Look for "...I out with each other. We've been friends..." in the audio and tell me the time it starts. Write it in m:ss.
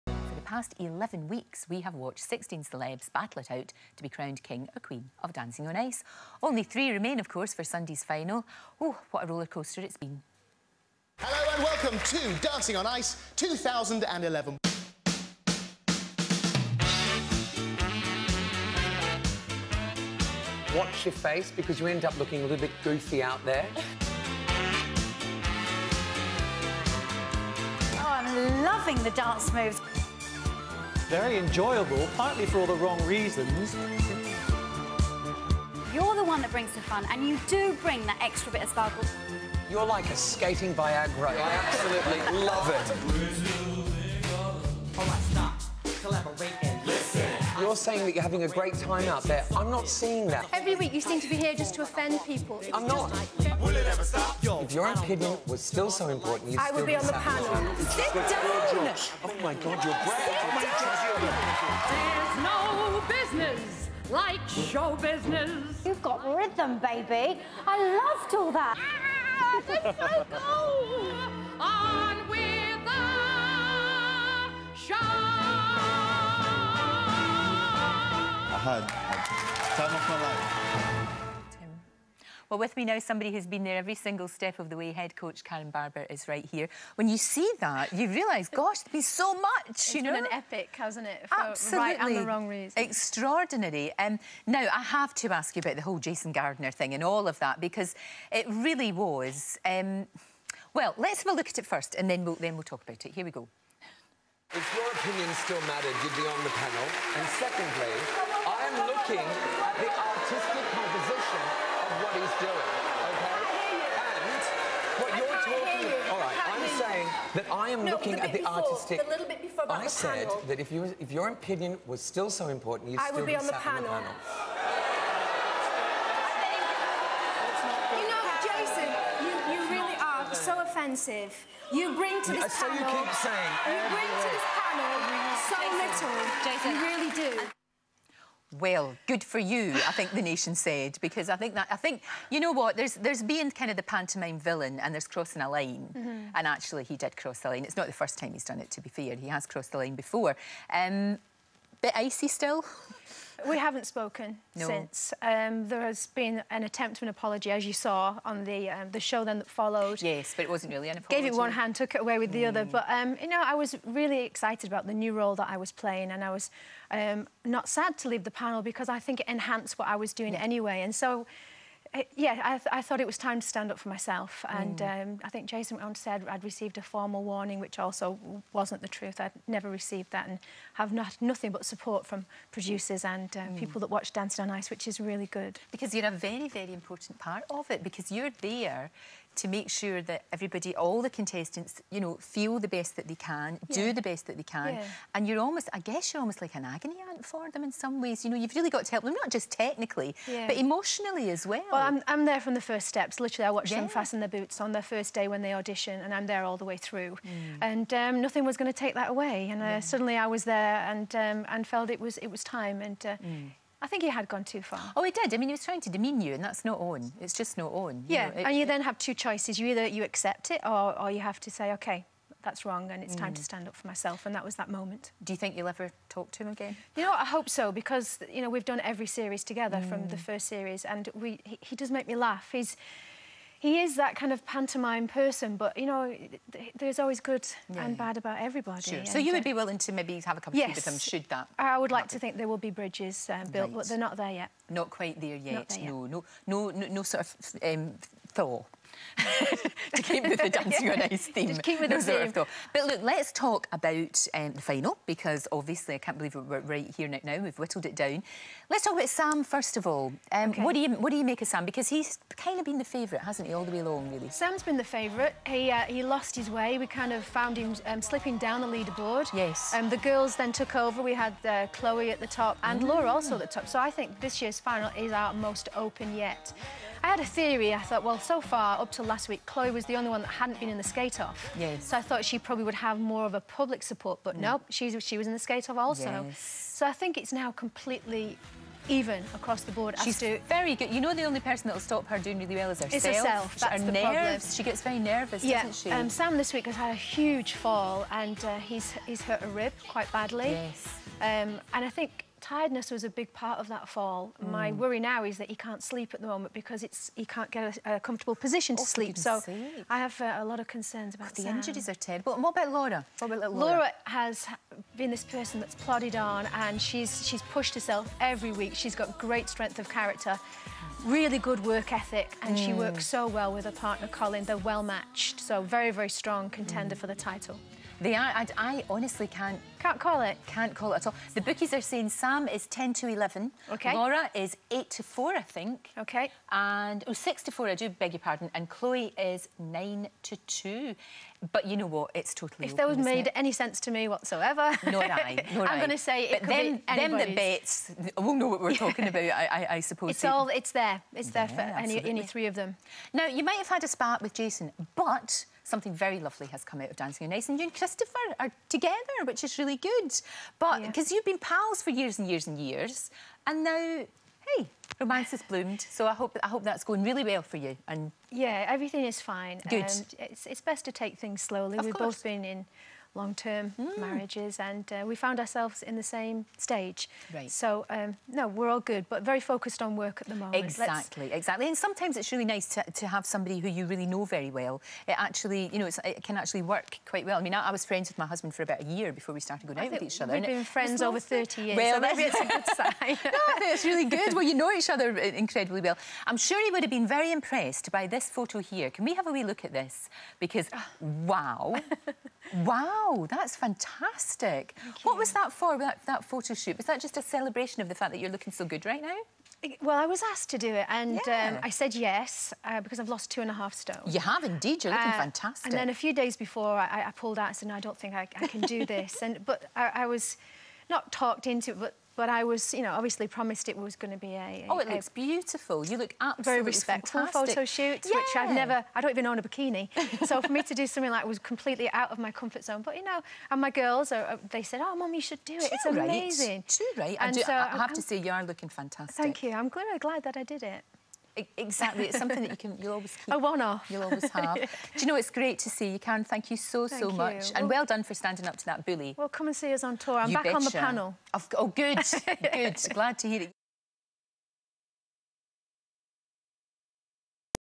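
6:29.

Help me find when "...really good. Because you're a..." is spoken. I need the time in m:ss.
3:04.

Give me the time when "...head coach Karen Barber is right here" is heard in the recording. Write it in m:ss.
1:24.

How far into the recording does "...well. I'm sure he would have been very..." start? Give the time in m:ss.
6:35.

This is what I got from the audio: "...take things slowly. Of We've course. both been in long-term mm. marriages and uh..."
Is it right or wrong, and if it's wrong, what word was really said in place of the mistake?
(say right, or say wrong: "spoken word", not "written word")
right.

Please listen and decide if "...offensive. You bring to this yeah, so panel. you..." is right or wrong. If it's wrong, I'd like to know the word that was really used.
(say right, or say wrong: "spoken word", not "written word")
right.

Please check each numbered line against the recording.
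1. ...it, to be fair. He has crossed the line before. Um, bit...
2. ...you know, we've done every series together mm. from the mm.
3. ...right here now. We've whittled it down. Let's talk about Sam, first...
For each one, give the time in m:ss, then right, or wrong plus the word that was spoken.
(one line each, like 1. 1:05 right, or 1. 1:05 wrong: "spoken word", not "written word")
1. 2:28 right
2. 3:48 right
3. 4:16 right.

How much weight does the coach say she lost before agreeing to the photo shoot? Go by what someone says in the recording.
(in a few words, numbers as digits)
two and a half stone.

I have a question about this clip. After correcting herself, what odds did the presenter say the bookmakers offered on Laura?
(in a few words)
6 to 4.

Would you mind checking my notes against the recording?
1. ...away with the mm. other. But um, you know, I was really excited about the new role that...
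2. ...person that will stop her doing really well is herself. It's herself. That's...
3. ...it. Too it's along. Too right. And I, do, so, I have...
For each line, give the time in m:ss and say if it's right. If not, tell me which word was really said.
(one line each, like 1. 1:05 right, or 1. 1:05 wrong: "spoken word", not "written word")
1. 2:42 right
2. 4:51 right
3. 7:15 wrong: "amazing", not "along".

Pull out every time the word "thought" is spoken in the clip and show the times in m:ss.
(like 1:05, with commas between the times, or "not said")
2:52, 4:37, 4:42.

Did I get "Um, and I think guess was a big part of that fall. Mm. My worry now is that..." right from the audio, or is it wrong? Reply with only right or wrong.
wrong.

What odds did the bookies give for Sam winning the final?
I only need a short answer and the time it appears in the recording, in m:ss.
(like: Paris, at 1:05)
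10 to 11, at 5:32.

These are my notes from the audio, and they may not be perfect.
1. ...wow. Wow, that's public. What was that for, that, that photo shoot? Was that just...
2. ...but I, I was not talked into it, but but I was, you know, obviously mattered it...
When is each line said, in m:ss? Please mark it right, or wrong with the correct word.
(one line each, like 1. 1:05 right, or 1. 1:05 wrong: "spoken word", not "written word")
1. 6:42 wrong: "fantastic", not "public"
2. 6:59 wrong: "promised", not "mattered".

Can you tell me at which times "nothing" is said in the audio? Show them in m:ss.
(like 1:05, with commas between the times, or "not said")
3:01, 3:28.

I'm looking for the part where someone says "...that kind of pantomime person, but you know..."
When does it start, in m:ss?
3:53.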